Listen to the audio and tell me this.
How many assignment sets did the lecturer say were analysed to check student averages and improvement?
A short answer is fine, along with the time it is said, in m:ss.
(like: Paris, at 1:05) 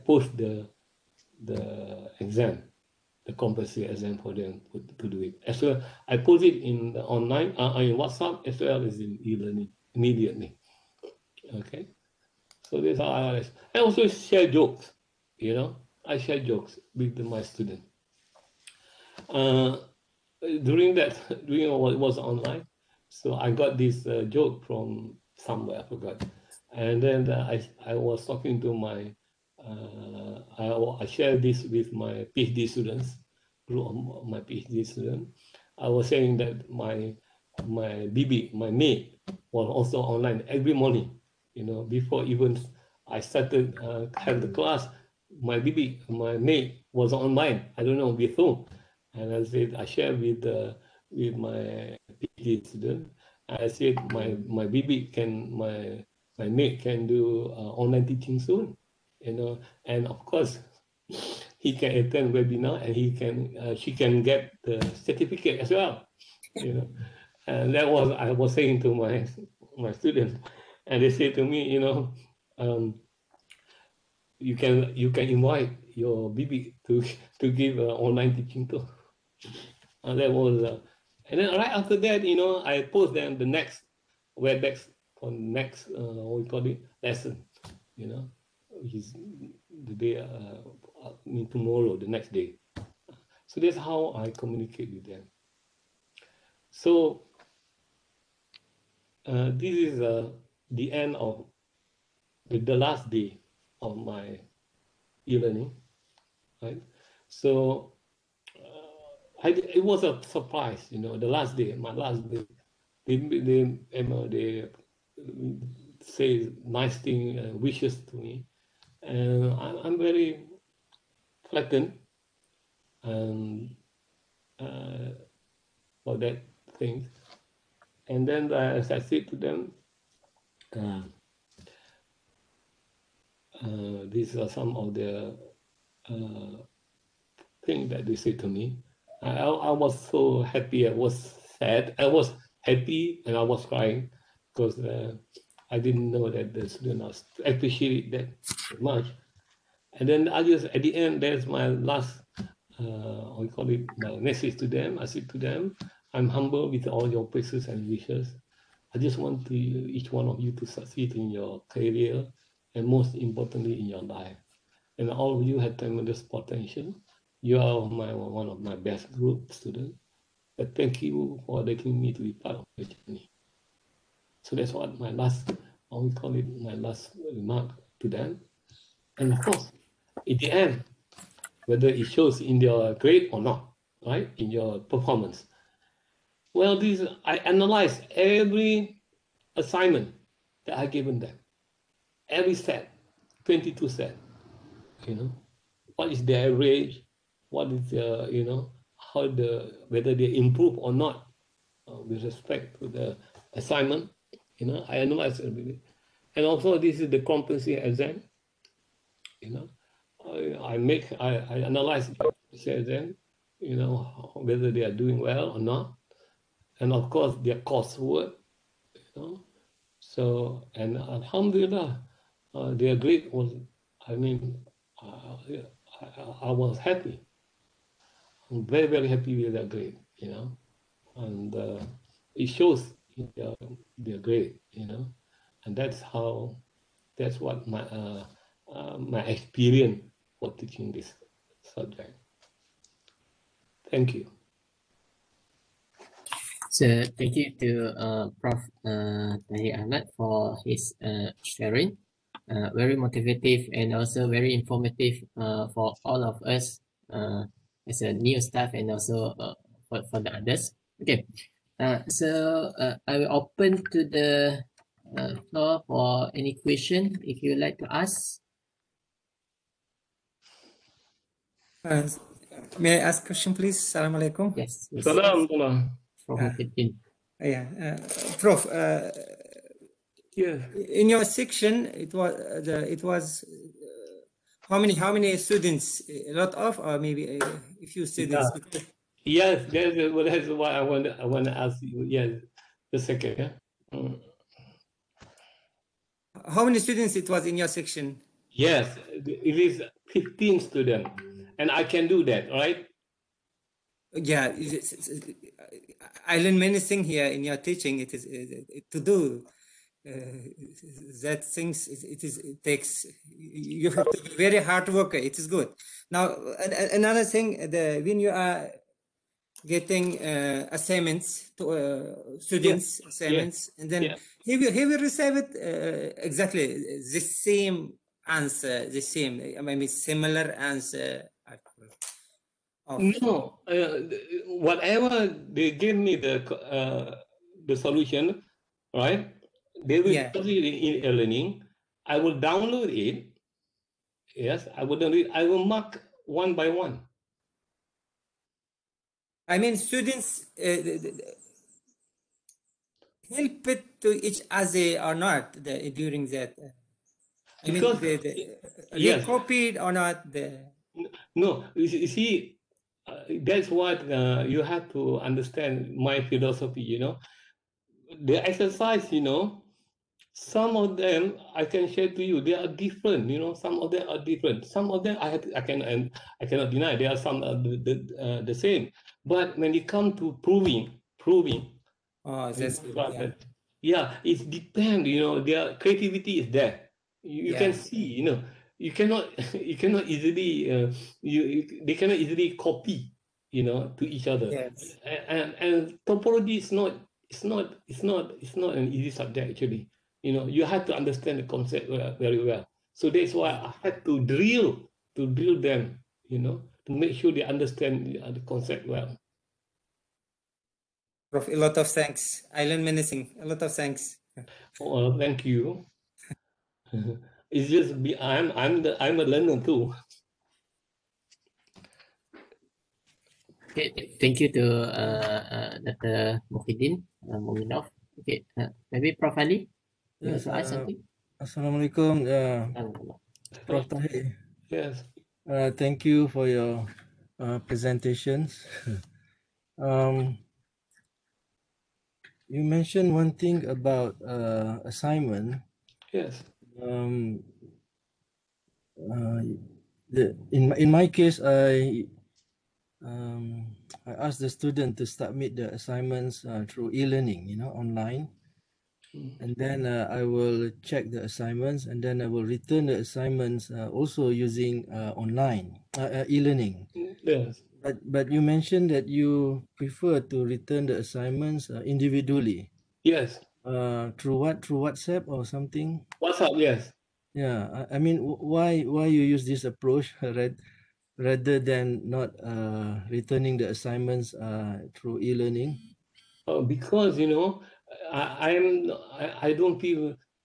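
22, at 3:13.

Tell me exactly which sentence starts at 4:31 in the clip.
Uh, may I ask a question, please?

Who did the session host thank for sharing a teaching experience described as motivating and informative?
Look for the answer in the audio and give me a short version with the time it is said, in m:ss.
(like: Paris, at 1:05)
Tahir Ahmad, at 4:09.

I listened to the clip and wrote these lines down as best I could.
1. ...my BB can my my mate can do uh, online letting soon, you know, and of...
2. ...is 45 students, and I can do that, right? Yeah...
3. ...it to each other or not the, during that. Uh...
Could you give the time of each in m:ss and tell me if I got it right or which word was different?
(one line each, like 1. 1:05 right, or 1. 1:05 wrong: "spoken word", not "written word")
1. 0:54 wrong: "teaching", not "letting"
2. 4:59 wrong: "15", not "45"
3. 5:53 right.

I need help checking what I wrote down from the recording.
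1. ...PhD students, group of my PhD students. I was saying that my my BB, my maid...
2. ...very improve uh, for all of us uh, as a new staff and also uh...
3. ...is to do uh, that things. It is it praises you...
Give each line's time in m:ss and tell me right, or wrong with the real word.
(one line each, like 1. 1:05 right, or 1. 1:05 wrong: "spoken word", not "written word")
1. 0:32 right
2. 4:14 wrong: "informative", not "improve"
3. 5:08 wrong: "takes", not "praises".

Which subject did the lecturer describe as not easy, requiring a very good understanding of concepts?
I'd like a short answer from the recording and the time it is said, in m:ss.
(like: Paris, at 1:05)
topology, at 6:36.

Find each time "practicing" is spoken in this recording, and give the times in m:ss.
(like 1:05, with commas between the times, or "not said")
not said.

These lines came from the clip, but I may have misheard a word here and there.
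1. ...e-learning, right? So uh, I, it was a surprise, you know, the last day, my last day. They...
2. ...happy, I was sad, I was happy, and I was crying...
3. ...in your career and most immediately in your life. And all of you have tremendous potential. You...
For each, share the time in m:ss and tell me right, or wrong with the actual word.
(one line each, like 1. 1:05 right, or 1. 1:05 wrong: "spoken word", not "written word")
1. 1:45 right
2. 2:20 right
3. 2:41 wrong: "importantly", not "immediately".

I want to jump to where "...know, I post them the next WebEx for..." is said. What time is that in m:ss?
1:22.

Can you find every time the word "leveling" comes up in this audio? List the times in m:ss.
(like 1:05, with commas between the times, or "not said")
not said.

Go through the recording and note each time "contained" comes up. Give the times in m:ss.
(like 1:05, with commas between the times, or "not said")
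not said.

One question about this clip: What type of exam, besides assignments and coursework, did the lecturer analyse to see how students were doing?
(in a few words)
competency exam.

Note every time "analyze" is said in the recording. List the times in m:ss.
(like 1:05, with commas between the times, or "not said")
3:07, 3:24, 3:31.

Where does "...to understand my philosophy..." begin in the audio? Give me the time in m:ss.
6:04.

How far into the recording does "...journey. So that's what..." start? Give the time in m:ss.
2:52.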